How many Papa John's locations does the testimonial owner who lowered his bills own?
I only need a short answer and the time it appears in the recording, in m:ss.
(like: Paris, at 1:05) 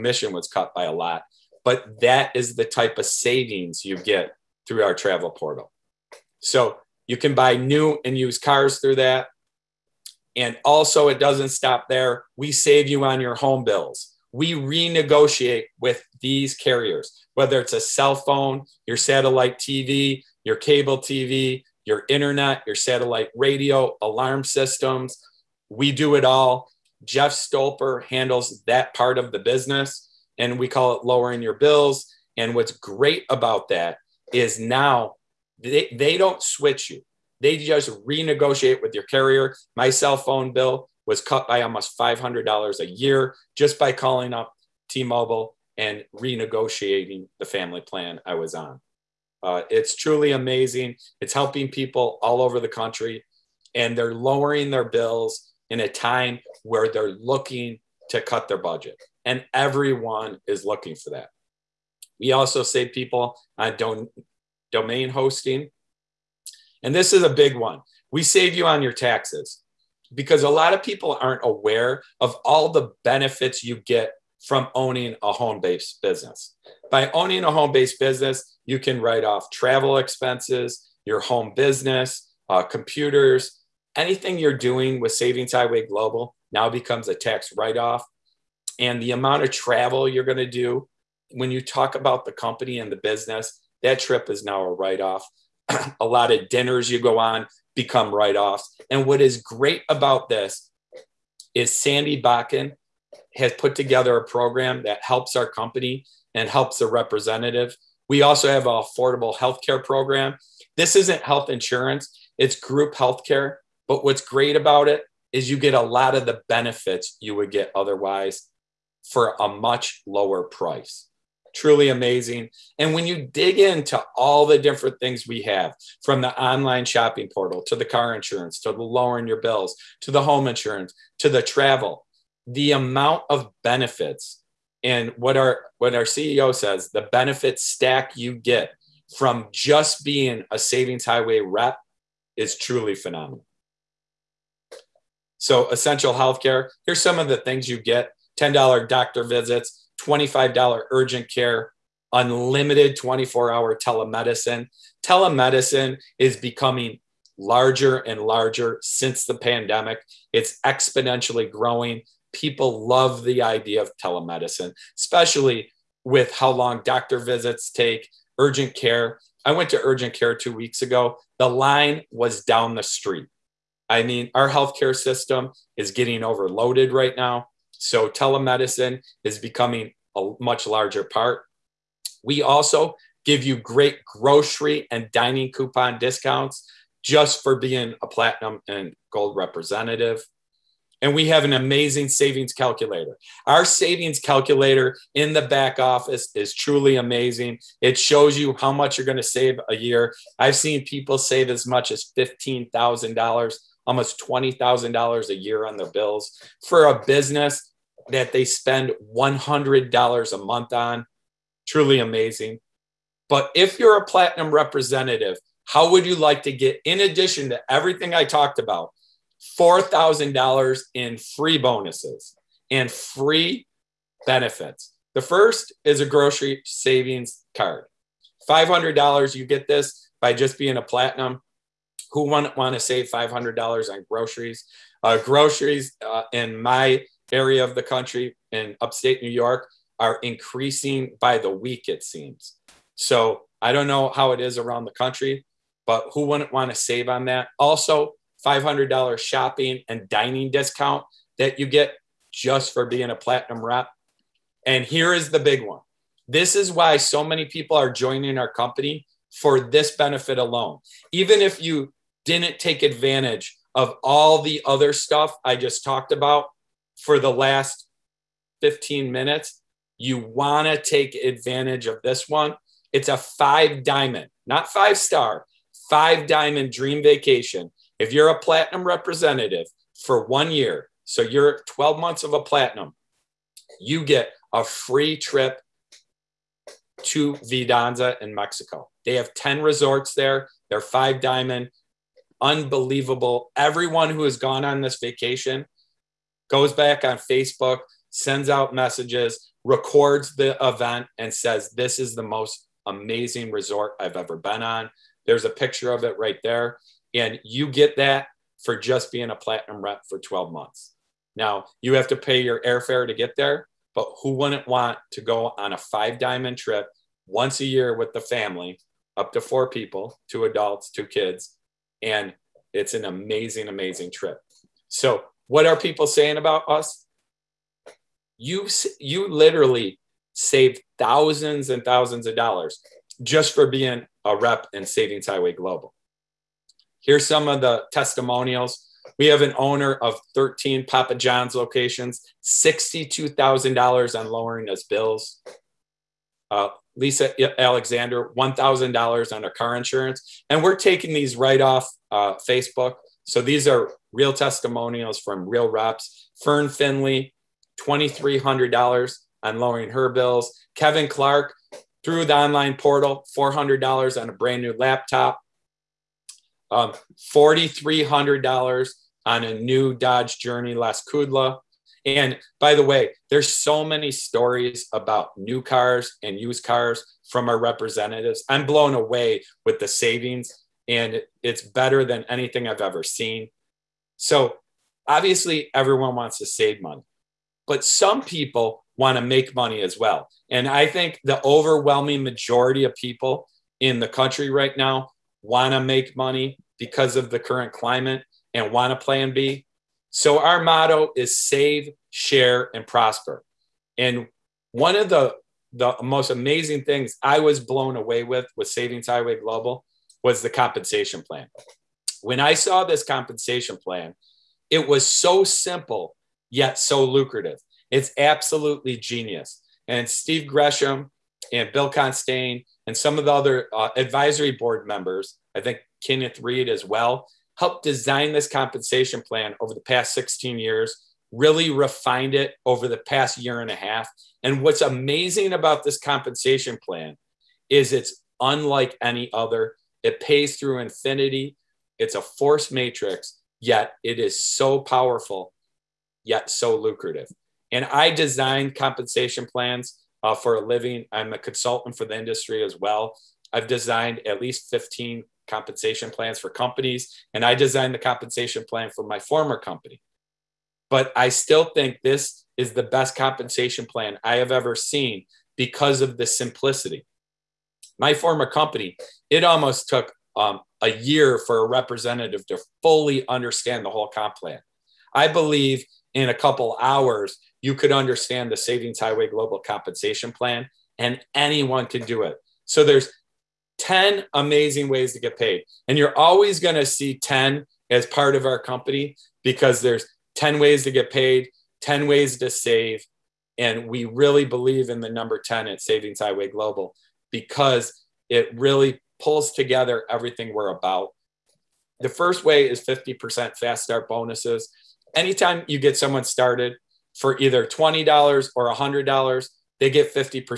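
13, at 5:40.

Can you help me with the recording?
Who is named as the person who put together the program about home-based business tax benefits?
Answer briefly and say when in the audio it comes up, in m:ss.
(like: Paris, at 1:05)
Sandy Bakken, at 1:41.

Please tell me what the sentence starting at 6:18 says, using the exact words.
I'm blown away with the savings, and it's better than anything I've ever seen.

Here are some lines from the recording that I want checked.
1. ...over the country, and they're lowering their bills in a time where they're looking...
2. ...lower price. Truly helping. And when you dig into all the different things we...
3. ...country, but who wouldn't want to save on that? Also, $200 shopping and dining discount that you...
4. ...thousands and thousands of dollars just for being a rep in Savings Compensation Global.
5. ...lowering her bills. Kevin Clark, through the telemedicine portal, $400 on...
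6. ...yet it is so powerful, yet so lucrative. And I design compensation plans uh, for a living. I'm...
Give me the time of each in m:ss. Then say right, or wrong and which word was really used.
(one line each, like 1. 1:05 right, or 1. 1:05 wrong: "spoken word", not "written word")
1. 0:52 right
2. 2:00 wrong: "amazing", not "helping"
3. 4:04 wrong: "500", not "200"
4. 5:30 wrong: "Highway", not "Compensation"
5. 5:59 wrong: "online", not "telemedicine"
6. 7:23 right.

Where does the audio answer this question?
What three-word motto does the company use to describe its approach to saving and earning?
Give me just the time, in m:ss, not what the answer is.
6:41.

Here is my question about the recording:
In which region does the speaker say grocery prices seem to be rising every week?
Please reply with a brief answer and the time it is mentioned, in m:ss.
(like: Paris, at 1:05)
upstate New York, at 3:58.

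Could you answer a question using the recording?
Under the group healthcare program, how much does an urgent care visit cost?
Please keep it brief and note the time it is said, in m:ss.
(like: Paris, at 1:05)
$25, at 2:30.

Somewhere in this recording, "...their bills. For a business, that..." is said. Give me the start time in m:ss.
3:25.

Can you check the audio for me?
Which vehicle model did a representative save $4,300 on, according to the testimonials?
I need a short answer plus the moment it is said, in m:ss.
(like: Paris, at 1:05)
Dodge Journey, at 6:09.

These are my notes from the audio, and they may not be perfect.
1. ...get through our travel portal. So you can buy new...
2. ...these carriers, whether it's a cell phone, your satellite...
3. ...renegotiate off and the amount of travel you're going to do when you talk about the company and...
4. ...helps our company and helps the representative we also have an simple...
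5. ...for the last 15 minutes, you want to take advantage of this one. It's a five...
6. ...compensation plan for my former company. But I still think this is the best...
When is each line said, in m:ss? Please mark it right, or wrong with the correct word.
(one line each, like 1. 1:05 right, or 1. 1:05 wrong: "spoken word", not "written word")
1. 0:03 right
2. 0:16 right
3. 1:27 wrong: "write", not "renegotiate"
4. 1:45 wrong: "affordable", not "simple"
5. 4:27 right
6. 7:37 right.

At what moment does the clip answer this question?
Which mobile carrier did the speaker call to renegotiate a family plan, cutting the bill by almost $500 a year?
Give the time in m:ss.
0:44.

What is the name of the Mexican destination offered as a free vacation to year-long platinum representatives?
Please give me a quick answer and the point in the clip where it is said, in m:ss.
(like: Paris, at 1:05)
Vidanta, at 4:47.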